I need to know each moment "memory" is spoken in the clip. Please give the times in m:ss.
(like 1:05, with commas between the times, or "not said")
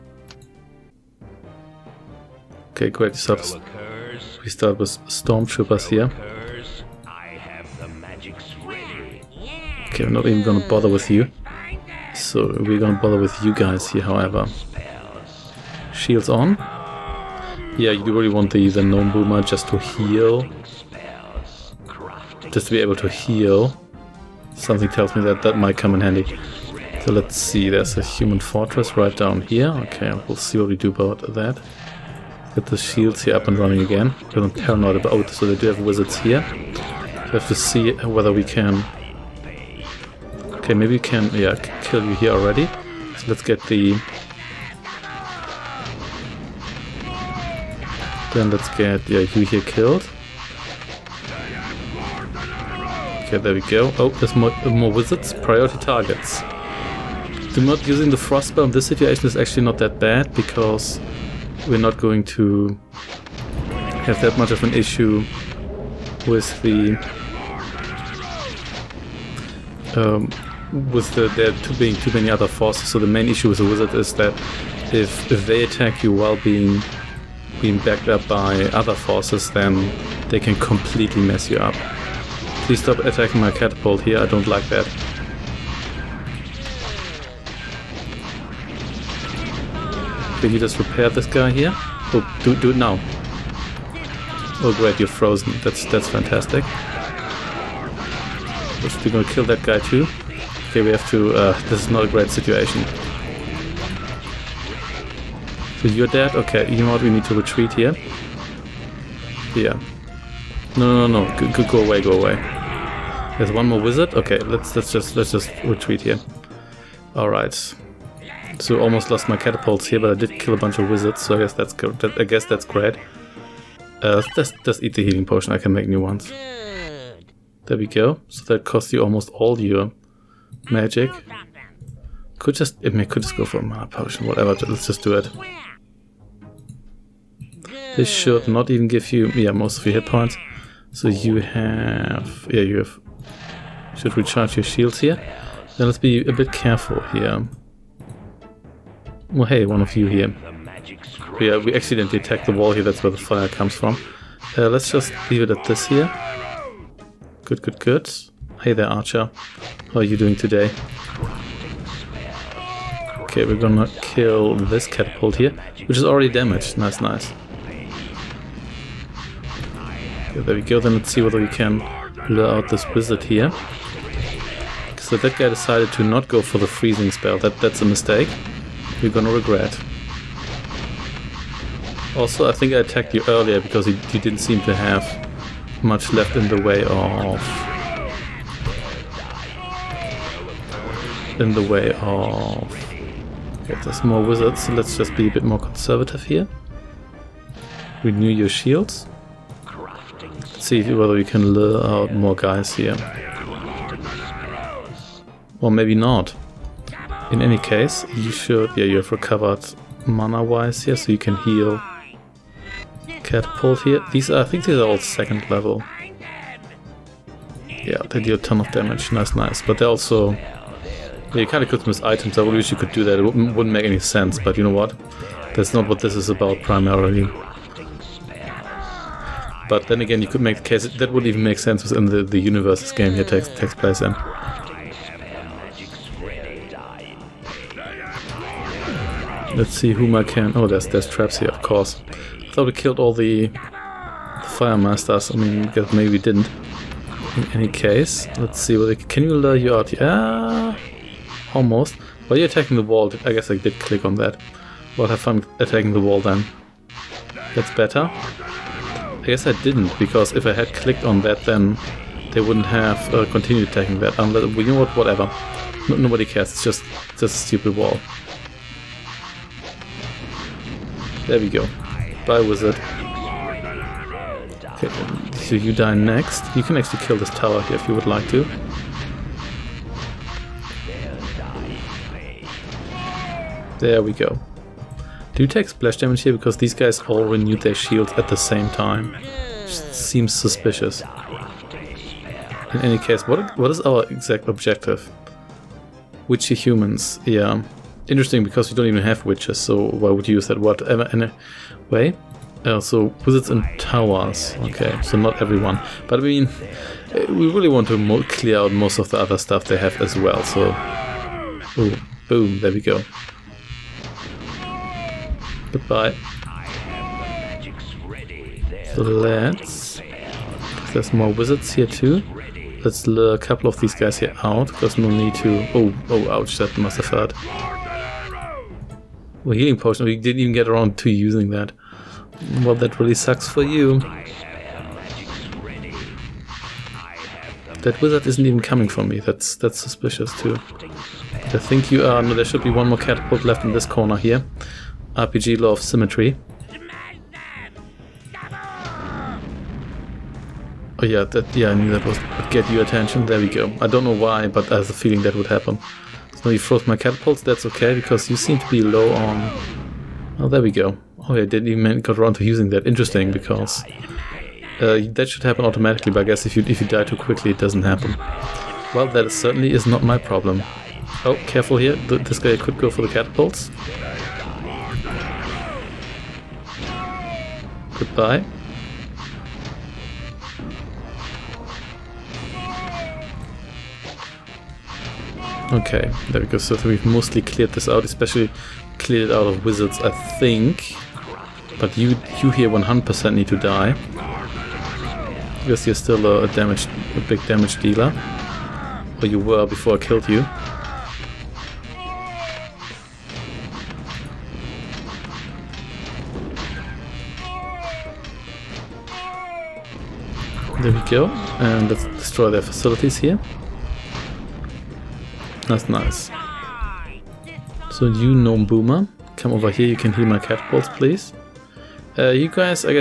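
not said.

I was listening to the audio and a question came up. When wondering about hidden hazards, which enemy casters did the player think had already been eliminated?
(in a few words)
fire masters.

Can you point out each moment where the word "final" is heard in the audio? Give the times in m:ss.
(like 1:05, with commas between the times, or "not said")
not said.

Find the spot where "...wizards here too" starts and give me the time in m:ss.
5:21.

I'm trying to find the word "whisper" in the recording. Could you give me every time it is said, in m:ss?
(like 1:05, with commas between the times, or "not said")
not said.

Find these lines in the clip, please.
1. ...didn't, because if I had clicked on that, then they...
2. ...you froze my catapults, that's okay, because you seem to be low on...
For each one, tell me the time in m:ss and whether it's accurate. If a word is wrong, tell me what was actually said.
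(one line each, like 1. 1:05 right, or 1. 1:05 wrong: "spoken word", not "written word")
1. 4:19 right
2. 5:56 right.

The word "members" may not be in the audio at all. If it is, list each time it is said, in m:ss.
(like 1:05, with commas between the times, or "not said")
not said.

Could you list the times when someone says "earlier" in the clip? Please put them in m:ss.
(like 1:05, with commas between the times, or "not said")
3:03.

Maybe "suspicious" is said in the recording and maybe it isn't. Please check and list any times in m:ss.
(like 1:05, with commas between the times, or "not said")
4:50, 5:39.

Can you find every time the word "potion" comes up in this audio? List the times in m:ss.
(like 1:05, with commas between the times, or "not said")
2:05, 2:13, 5:29.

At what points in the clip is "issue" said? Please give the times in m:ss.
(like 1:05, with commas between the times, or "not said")
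1:04, 1:13.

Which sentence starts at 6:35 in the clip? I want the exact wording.
Because you're still a, a damage, a big damage dealer.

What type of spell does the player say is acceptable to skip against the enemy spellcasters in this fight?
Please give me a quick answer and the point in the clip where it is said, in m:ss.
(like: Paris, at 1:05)
frost spell, at 0:58.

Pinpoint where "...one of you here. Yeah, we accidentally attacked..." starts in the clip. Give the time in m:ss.
2:29.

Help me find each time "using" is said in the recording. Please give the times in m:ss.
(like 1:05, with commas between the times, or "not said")
0:57, 5:31, 6:02.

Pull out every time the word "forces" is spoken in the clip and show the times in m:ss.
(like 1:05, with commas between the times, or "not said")
1:12, 1:18.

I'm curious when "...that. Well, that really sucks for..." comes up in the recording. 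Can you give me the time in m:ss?
5:31.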